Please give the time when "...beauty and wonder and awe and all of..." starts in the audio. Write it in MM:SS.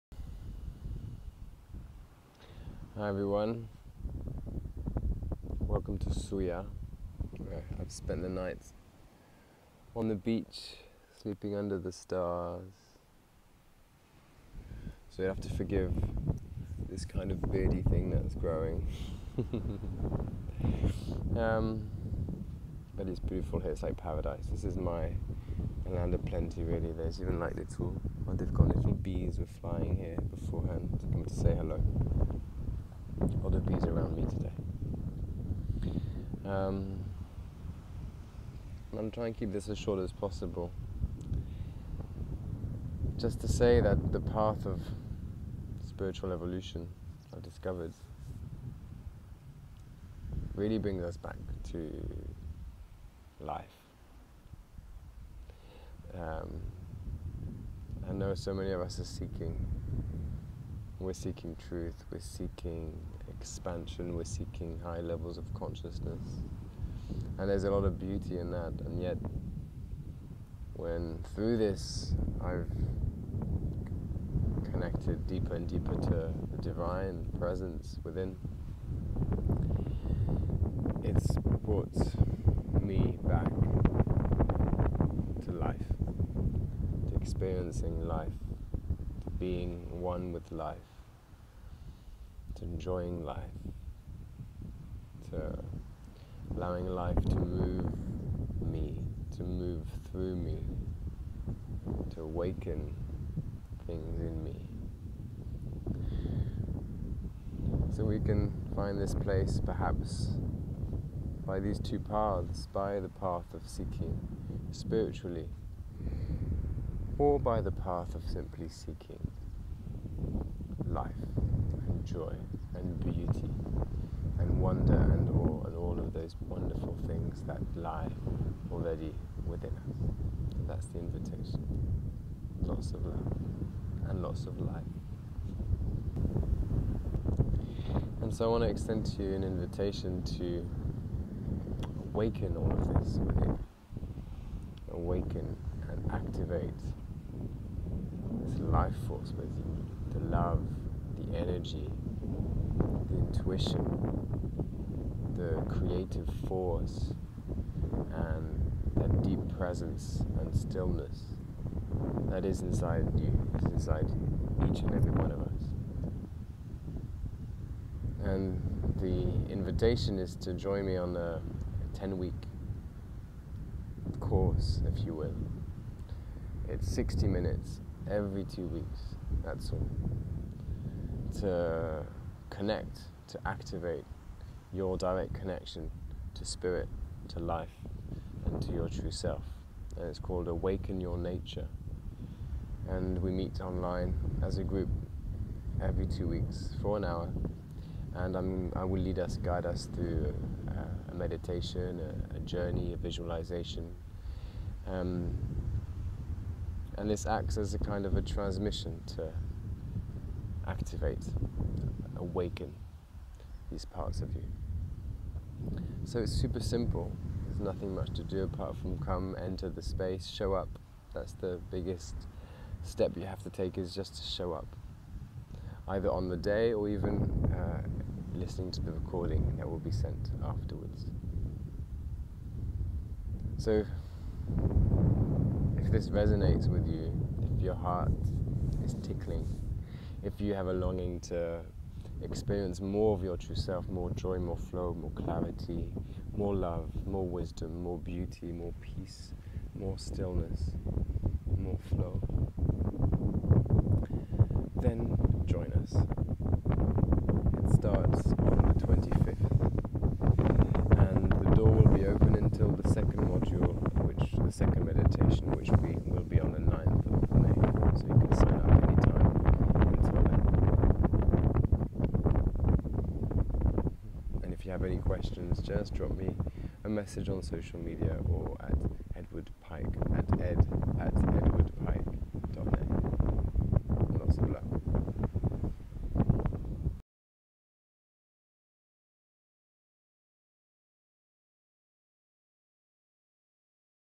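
02:02.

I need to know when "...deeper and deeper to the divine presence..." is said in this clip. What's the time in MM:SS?
01:15.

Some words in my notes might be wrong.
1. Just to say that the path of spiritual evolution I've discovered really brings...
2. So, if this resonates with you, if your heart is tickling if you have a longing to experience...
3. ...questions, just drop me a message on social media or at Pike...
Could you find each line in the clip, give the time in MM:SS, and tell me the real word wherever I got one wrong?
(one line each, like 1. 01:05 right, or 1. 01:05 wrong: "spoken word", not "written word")
1. 00:43 right
2. 03:53 right
3. 04:35 wrong: "Edward", not "Pike".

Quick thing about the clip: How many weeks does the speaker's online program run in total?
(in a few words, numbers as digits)
10.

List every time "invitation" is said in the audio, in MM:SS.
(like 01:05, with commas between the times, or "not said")
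02:10, 02:19, 02:49.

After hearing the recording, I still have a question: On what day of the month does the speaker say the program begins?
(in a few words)
25th.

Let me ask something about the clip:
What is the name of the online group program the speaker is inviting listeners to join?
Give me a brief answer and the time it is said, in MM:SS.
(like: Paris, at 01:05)
Awaken Your Nature, at 03:10.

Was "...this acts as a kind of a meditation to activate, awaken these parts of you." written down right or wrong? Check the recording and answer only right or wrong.
wrong.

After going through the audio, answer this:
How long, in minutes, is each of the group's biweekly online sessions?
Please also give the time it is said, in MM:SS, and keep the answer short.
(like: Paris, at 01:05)
60, at 02:56.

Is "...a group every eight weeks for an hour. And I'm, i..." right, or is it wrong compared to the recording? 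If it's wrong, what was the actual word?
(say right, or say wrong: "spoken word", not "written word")
wrong: "two", not "eight".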